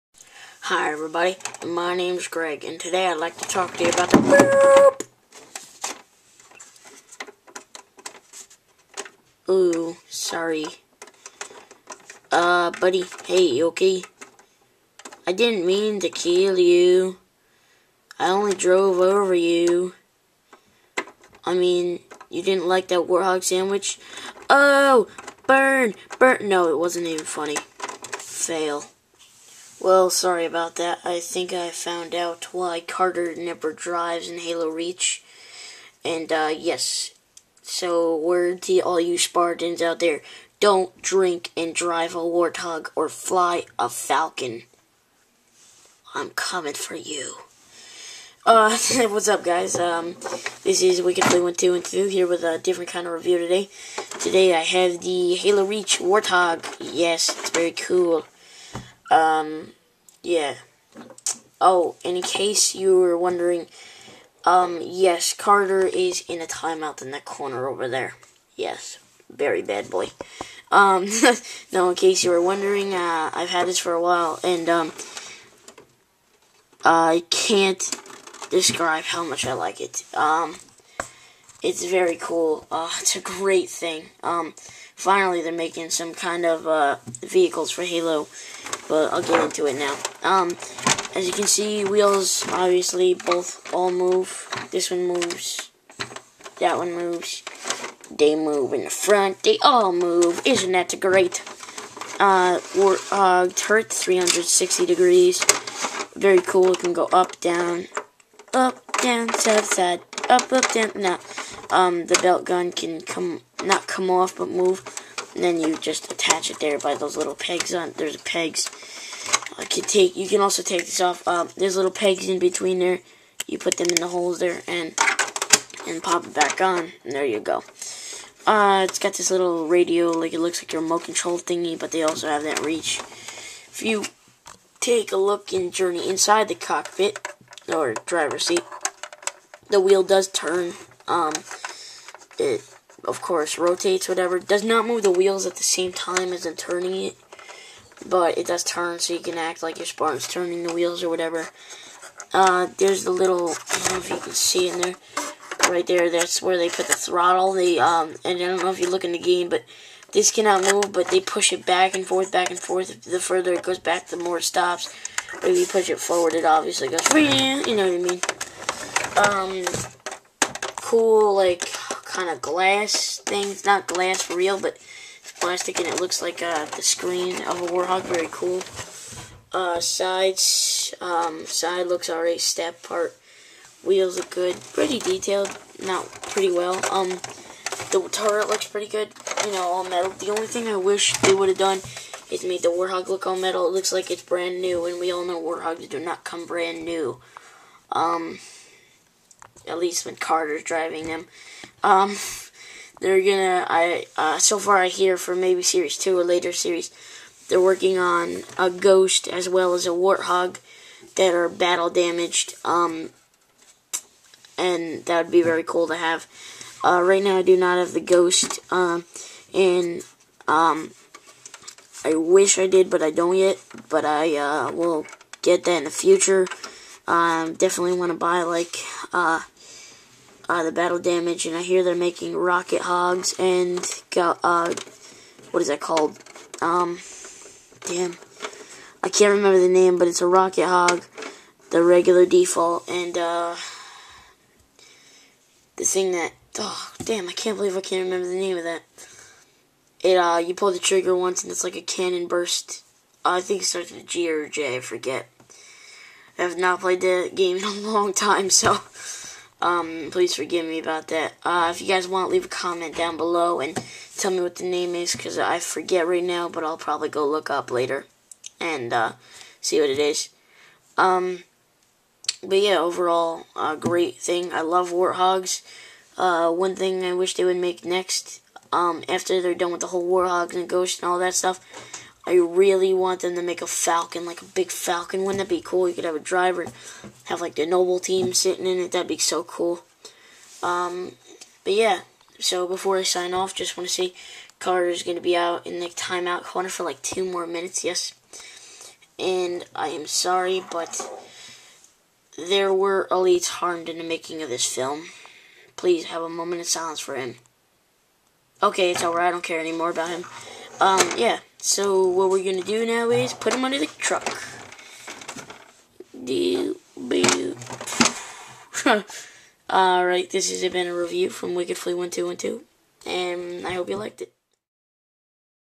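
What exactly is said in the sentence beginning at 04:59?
And I am sorry, but there were elites harmed in the making of this film.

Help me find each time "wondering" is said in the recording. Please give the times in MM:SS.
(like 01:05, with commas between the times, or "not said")
01:03, 01:12.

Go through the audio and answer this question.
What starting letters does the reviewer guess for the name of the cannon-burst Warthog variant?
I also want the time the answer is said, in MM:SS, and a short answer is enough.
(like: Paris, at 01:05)
G or J, at 04:14.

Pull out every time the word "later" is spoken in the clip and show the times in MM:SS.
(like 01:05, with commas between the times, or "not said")
03:26, 04:27.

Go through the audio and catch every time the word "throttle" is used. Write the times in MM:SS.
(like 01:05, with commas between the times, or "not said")
02:36.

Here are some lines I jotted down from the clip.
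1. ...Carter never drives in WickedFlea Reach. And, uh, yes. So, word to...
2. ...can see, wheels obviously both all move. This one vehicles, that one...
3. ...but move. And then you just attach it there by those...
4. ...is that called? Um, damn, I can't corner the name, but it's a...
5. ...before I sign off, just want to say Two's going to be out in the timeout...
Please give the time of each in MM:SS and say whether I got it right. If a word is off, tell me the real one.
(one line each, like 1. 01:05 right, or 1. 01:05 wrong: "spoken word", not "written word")
1. 00:32 wrong: "Halo", not "WickedFlea"
2. 01:31 wrong: "moves", not "vehicles"
3. 01:54 right
4. 03:55 wrong: "remember", not "corner"
5. 04:52 wrong: "Carter", not "Two".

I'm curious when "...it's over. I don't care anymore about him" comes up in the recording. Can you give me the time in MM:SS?
05:08.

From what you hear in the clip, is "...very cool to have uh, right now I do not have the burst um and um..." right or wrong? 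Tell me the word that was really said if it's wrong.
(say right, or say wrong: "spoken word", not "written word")
wrong: "ghost", not "burst".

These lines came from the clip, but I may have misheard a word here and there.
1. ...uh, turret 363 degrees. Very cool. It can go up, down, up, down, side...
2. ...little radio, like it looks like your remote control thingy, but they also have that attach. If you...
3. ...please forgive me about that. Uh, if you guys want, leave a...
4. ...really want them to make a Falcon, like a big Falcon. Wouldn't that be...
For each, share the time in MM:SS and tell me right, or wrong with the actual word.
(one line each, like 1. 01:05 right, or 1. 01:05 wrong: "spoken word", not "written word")
1. 01:43 wrong: "360", not "363"
2. 02:09 wrong: "reach", not "attach"
3. 04:20 right
4. 04:42 right.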